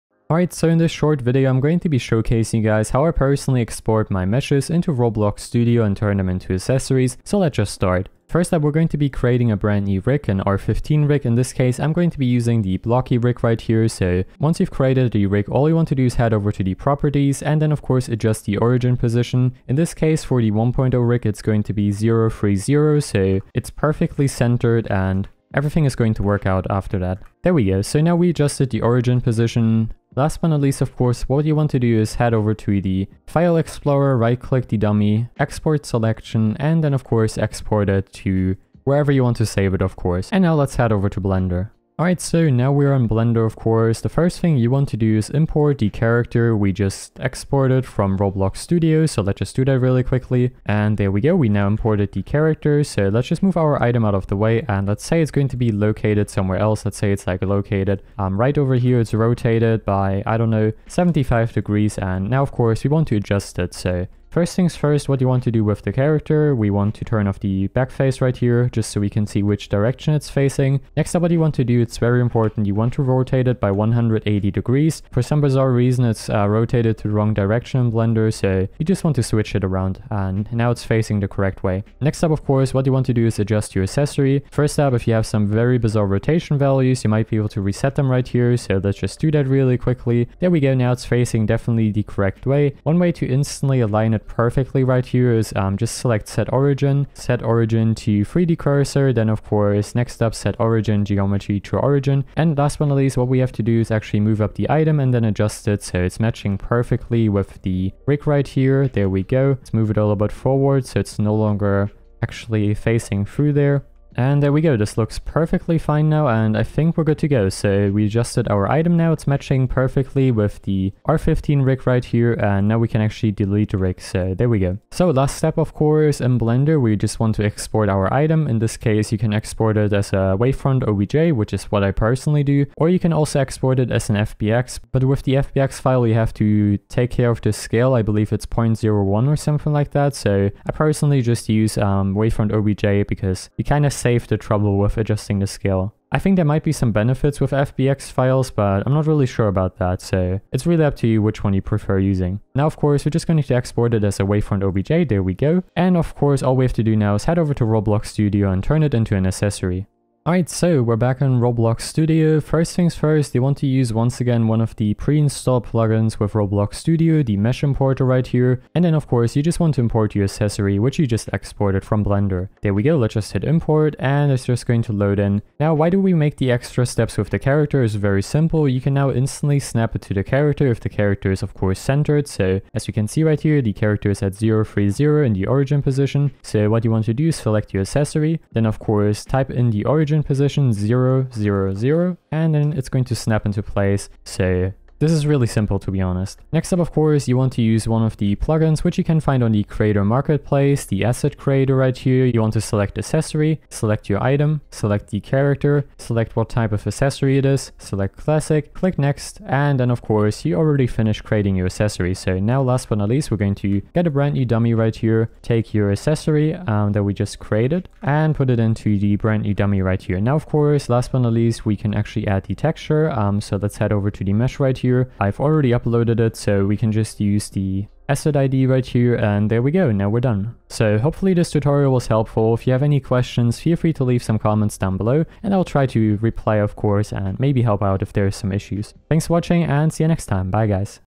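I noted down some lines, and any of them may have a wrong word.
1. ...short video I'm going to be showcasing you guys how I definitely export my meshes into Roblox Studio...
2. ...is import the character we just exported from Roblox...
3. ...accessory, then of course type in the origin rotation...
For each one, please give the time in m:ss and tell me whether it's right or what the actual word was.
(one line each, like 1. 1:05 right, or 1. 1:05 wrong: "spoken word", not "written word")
1. 0:00 wrong: "personally", not "definitely"
2. 0:45 right
3. 3:07 wrong: "position", not "rotation".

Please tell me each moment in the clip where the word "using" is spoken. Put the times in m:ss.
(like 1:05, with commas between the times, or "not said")
0:12, 2:31.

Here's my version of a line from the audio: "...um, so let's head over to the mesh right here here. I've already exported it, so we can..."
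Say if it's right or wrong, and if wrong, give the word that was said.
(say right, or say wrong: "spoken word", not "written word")
wrong: "uploaded", not "exported".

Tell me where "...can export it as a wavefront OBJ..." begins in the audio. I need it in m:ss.
2:09.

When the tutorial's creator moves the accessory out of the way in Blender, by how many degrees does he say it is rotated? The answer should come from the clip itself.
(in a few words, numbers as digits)
75 degrees.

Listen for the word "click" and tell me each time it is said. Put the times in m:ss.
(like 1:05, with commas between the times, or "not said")
0:34, 3:28.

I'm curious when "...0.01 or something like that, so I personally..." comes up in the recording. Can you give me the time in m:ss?
2:18.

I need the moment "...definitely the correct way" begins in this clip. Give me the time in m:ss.
1:31.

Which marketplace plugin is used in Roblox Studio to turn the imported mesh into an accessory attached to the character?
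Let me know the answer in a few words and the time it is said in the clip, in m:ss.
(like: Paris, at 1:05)
Asset creator, at 3:20.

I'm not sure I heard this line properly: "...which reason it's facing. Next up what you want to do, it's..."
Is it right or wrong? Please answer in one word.
wrong.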